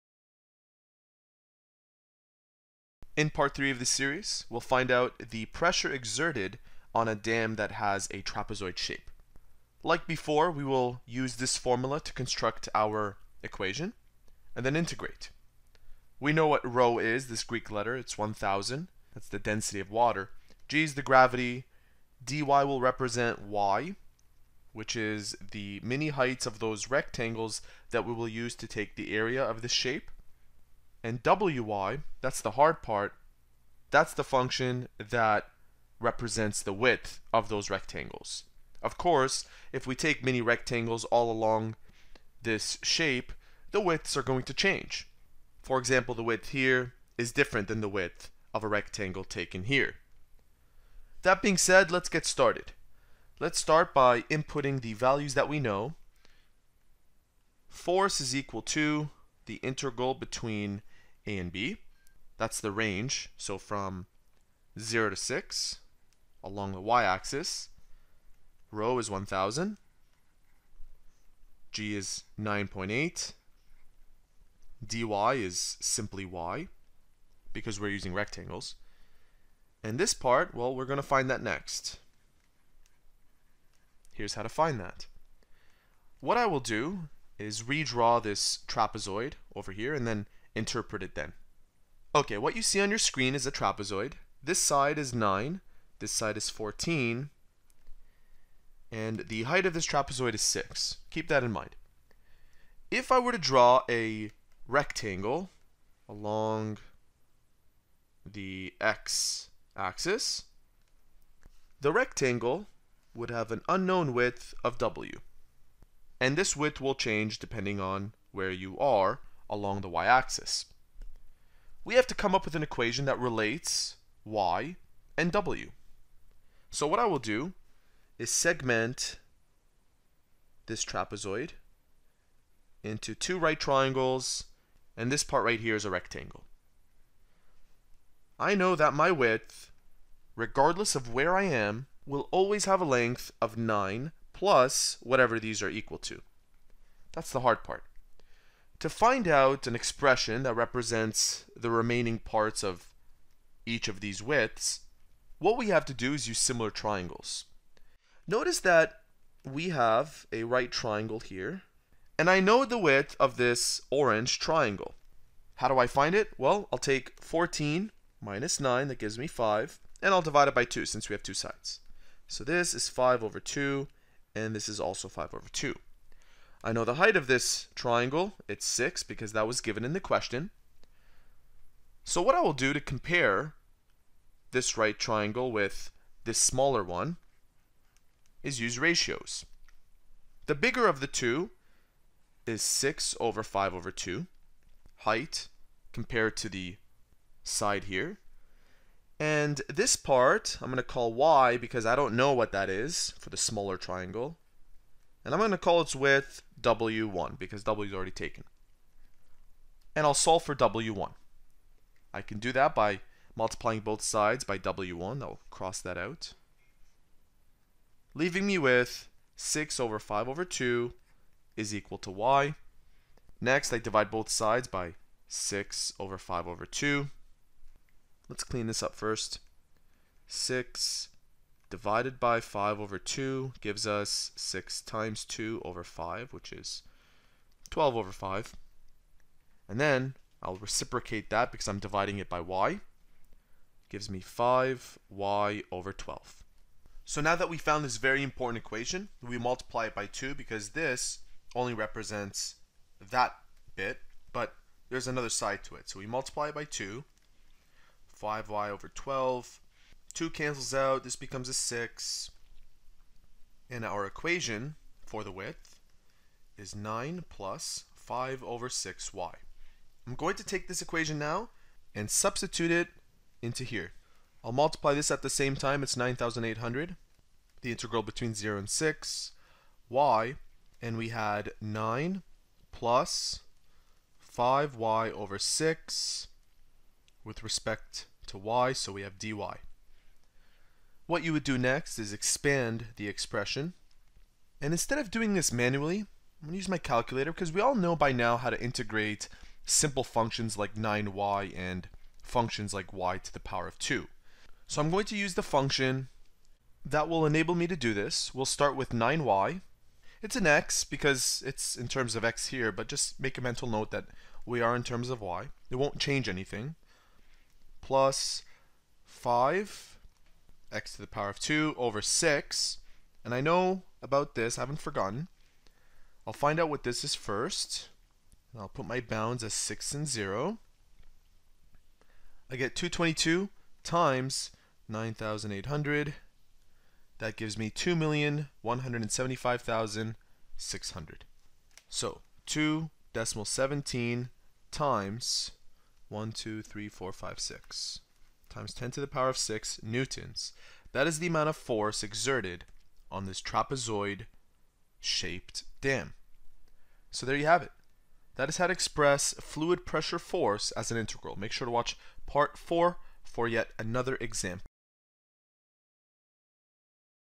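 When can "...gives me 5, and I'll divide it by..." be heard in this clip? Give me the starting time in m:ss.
2:48.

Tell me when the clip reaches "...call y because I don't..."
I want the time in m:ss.
3:20.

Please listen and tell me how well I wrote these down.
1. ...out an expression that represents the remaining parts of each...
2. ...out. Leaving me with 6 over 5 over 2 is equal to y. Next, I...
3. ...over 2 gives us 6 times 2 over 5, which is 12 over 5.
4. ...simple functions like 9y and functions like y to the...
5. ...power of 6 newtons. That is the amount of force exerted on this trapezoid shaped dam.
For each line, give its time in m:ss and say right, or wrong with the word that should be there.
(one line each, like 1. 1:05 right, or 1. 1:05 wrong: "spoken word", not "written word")
1. 2:29 right
2. 3:35 right
3. 3:52 right
4. 4:59 right
5. 5:49 right.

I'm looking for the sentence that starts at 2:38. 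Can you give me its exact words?
Notice that we have a right triangle here, and I know the width of this orange triangle.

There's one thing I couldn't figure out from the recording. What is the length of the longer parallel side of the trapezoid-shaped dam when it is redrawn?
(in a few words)
14.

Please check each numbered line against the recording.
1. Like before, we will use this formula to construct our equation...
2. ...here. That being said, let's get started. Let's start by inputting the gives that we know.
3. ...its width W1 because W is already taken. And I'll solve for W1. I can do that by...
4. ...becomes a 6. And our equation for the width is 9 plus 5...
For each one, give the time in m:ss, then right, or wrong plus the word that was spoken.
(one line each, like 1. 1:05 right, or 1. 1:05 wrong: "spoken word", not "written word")
1. 0:09 right
2. 0:49 wrong: "values", not "gives"
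3. 3:25 right
4. 4:21 right.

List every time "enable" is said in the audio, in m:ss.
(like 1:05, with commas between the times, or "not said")
5:07.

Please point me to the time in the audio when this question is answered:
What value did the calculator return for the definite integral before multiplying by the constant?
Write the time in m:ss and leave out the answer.
5:32.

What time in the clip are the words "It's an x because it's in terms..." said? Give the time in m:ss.
5:10.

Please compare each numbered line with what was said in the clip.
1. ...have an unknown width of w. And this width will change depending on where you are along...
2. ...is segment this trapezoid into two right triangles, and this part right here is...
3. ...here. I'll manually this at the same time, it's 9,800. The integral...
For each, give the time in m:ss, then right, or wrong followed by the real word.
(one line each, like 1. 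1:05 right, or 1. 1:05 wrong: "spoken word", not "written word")
1. 1:53 right
2. 2:08 right
3. 4:33 wrong: "multiply", not "manually".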